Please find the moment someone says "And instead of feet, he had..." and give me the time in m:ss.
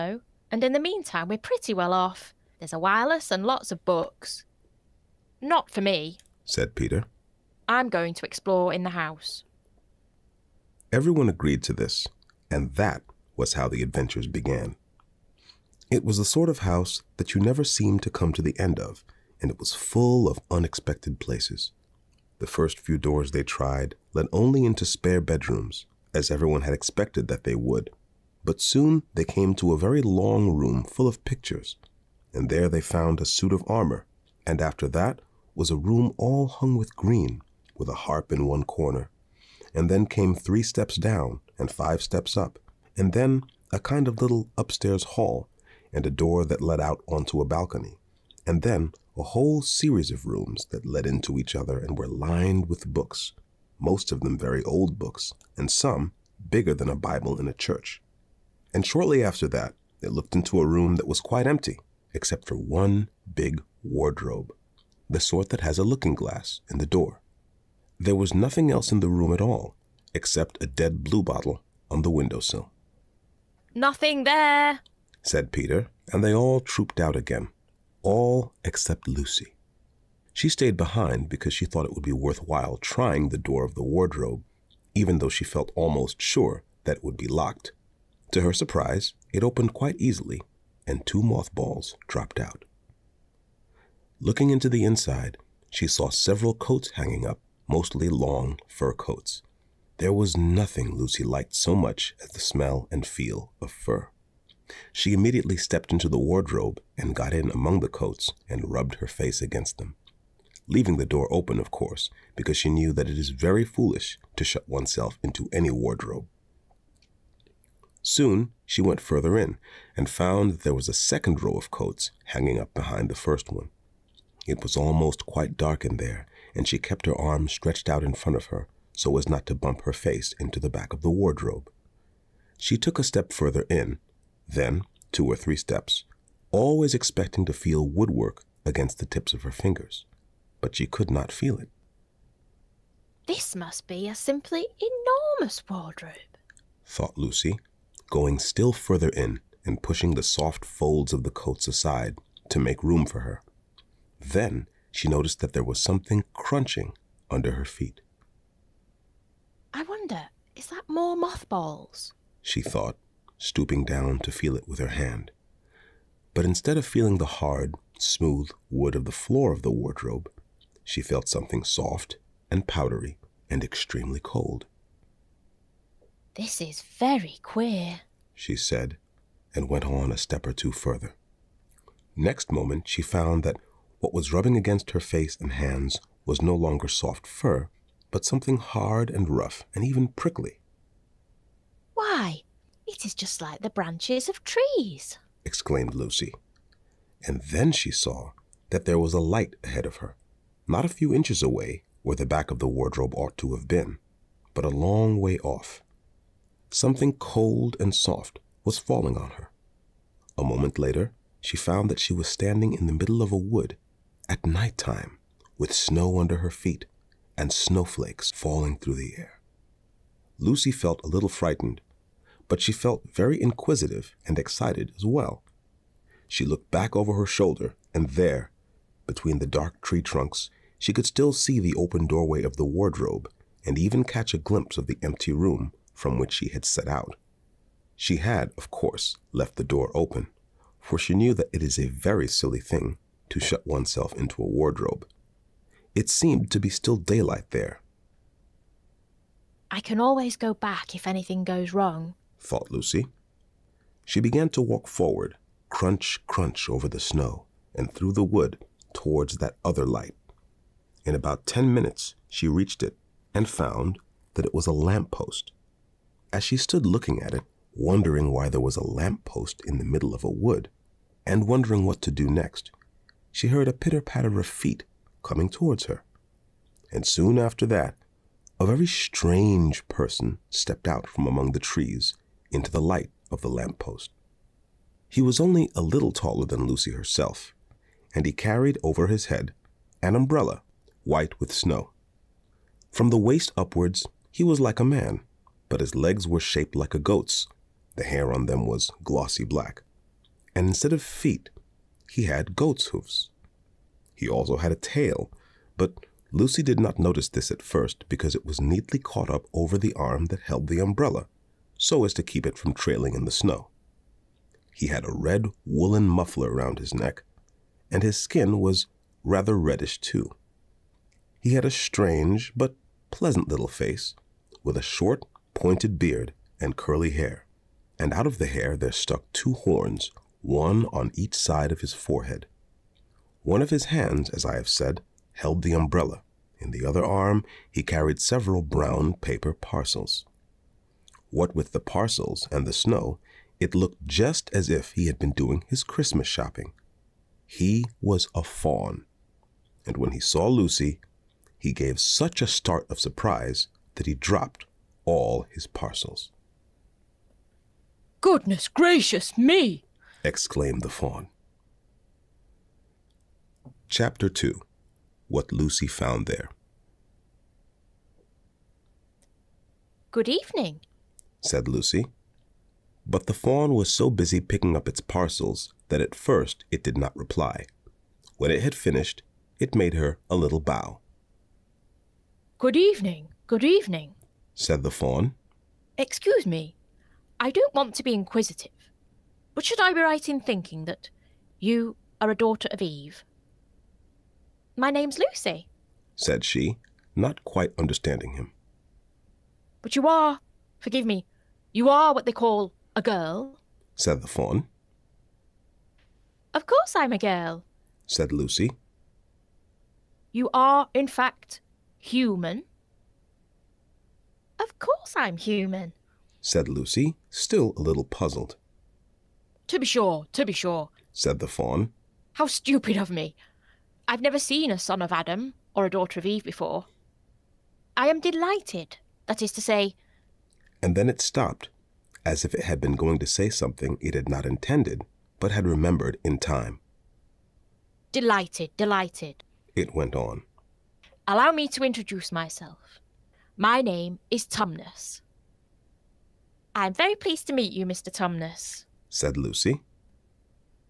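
5:00.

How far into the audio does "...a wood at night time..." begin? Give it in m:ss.
3:33.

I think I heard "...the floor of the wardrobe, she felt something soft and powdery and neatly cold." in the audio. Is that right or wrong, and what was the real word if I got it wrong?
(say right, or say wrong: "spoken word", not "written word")
wrong: "extremely", not "neatly".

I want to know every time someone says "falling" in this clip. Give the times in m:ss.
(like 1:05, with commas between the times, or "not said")
3:28, 3:38.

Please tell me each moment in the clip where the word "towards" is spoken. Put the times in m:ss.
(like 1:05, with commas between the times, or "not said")
4:18, 4:35.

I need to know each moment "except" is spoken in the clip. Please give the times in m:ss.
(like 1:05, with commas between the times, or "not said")
1:02, 1:10, 1:18.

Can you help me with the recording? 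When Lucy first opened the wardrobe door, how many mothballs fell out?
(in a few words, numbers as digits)
2.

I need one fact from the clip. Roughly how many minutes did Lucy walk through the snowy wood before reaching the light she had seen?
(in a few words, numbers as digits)
10.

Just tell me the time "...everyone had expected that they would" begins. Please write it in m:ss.
0:26.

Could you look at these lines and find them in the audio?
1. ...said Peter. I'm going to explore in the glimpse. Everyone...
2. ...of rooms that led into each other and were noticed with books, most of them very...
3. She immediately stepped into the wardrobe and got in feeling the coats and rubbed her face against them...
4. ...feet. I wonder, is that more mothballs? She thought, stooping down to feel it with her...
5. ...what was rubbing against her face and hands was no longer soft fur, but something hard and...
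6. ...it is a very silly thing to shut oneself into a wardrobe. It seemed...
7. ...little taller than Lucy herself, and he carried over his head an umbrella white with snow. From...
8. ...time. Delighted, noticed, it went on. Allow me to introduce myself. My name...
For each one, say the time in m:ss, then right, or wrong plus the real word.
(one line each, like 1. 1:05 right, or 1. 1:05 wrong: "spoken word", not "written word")
1. 0:06 wrong: "house", not "glimpse"
2. 0:50 wrong: "lined", not "noticed"
3. 1:44 wrong: "among", not "feeling"
4. 2:37 right
5. 3:04 right
6. 4:01 right
7. 4:45 right
8. 7:16 wrong: "delighted", not "noticed".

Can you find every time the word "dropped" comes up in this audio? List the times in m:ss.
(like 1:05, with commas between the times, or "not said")
1:32, 5:54.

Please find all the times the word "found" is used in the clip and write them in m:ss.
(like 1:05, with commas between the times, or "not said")
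0:32, 2:00, 3:03, 3:31, 4:23, 6:05.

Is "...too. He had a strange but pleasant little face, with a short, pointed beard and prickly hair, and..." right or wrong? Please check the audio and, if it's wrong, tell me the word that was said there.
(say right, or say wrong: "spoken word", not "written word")
wrong: "curly", not "prickly".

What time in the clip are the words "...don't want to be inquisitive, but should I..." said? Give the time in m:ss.
6:27.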